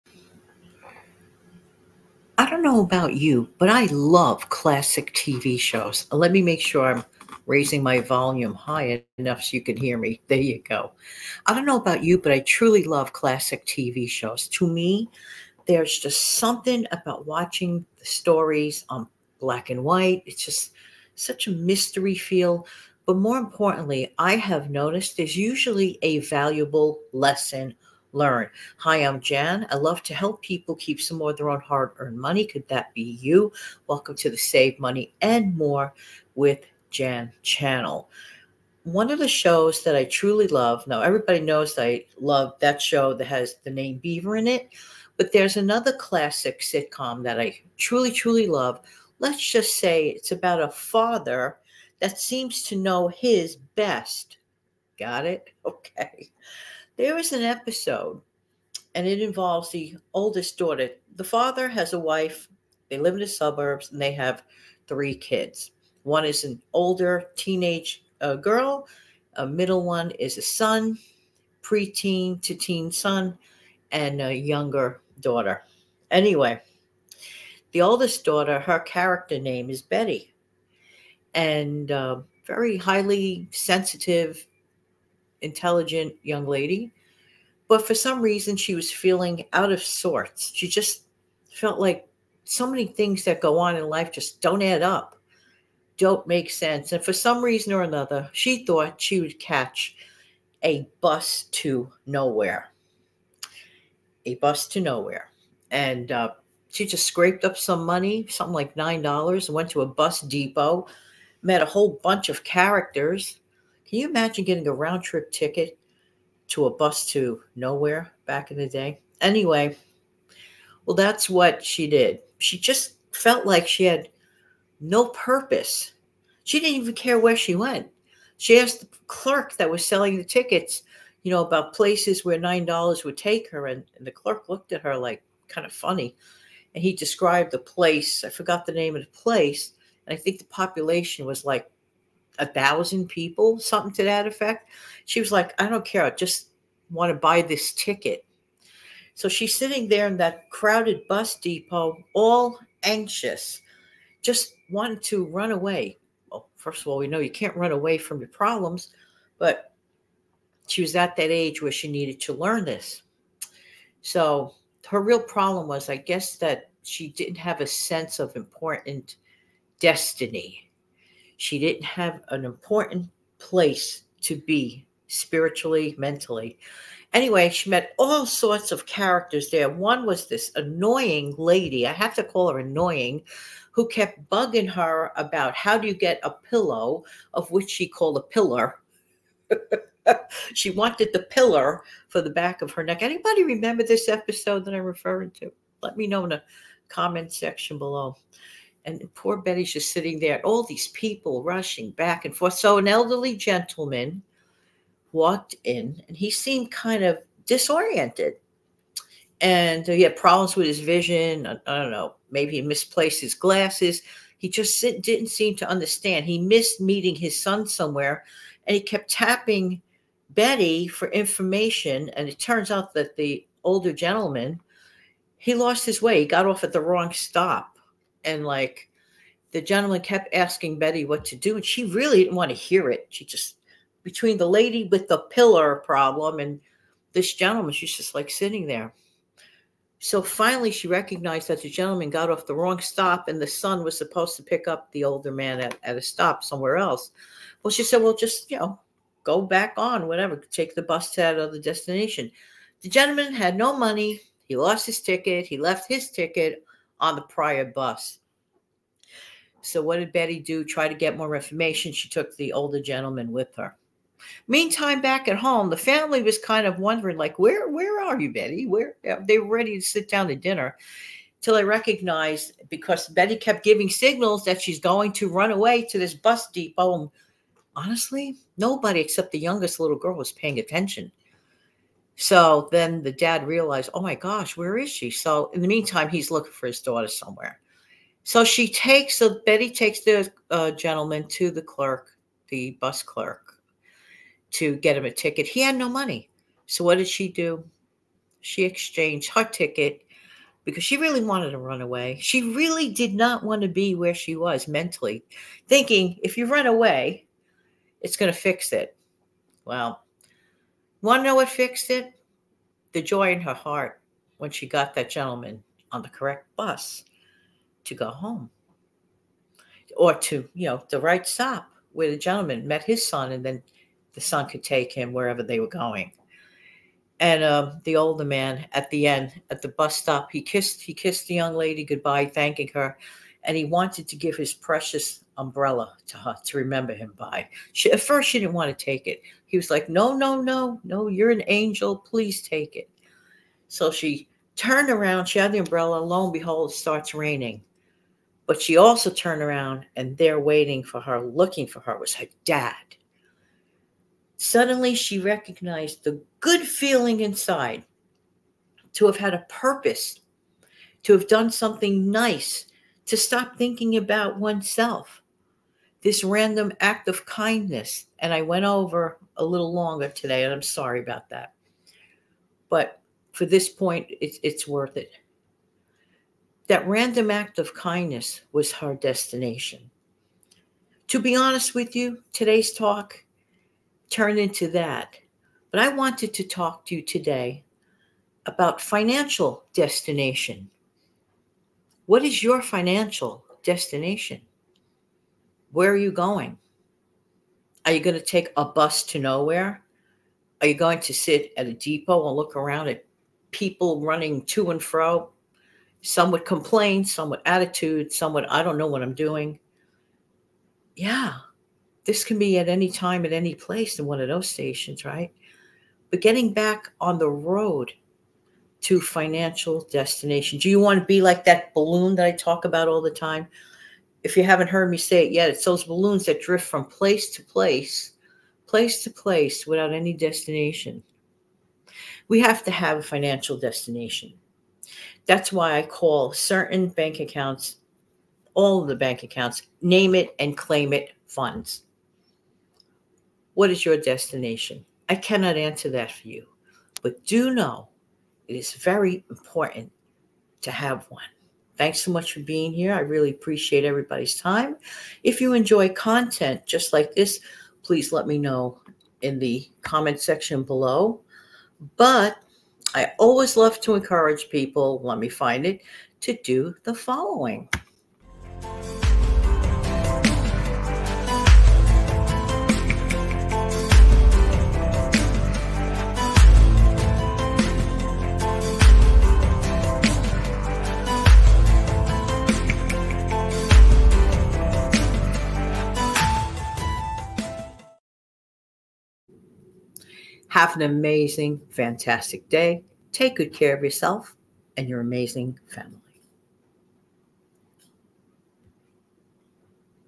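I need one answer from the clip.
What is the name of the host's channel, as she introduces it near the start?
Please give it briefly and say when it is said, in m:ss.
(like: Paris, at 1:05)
Save Money and More with Jan, at 0:34.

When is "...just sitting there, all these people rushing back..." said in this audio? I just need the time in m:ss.
3:19.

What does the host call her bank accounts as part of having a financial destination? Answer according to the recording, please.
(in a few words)
name it and claim it funds.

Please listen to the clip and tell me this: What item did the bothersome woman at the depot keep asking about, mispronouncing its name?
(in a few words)
pillow.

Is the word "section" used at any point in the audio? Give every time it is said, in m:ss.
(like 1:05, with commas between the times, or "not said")
3:17, 7:40.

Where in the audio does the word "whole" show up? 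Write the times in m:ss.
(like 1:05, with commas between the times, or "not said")
1:51.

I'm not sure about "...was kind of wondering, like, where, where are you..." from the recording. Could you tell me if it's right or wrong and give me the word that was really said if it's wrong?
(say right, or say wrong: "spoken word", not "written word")
right.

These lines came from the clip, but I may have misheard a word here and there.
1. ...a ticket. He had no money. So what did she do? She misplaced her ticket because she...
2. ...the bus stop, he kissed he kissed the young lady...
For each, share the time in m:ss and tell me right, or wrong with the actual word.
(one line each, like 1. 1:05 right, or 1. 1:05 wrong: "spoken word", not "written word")
1. 4:55 wrong: "exchanged", not "misplaced"
2. 5:29 right.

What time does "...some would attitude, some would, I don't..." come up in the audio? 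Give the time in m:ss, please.
6:47.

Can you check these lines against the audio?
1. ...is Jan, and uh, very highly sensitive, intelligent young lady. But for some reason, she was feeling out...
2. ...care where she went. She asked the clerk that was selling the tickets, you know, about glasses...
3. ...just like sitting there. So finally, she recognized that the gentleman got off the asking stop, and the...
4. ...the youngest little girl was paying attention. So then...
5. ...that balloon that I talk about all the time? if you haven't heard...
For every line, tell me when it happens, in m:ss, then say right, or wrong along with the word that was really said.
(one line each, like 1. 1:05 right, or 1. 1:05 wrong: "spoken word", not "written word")
1. 1:19 wrong: "Betty", not "Jan"
2. 2:06 wrong: "places", not "glasses"
3. 3:57 wrong: "wrong", not "asking"
4. 4:39 right
5. 7:01 right.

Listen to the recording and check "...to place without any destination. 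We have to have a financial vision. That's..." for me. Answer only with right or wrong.
wrong.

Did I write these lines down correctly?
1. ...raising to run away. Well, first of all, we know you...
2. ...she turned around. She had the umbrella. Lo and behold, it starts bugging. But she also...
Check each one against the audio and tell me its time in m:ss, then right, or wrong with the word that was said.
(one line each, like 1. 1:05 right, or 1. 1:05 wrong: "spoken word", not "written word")
1. 2:34 wrong: "wanting", not "raising"
2. 5:43 wrong: "raining", not "bugging".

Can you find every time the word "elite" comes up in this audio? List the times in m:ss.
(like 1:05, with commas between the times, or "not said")
not said.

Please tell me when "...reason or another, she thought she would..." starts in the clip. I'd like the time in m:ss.
1:37.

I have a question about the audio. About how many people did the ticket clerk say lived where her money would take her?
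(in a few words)
1,000.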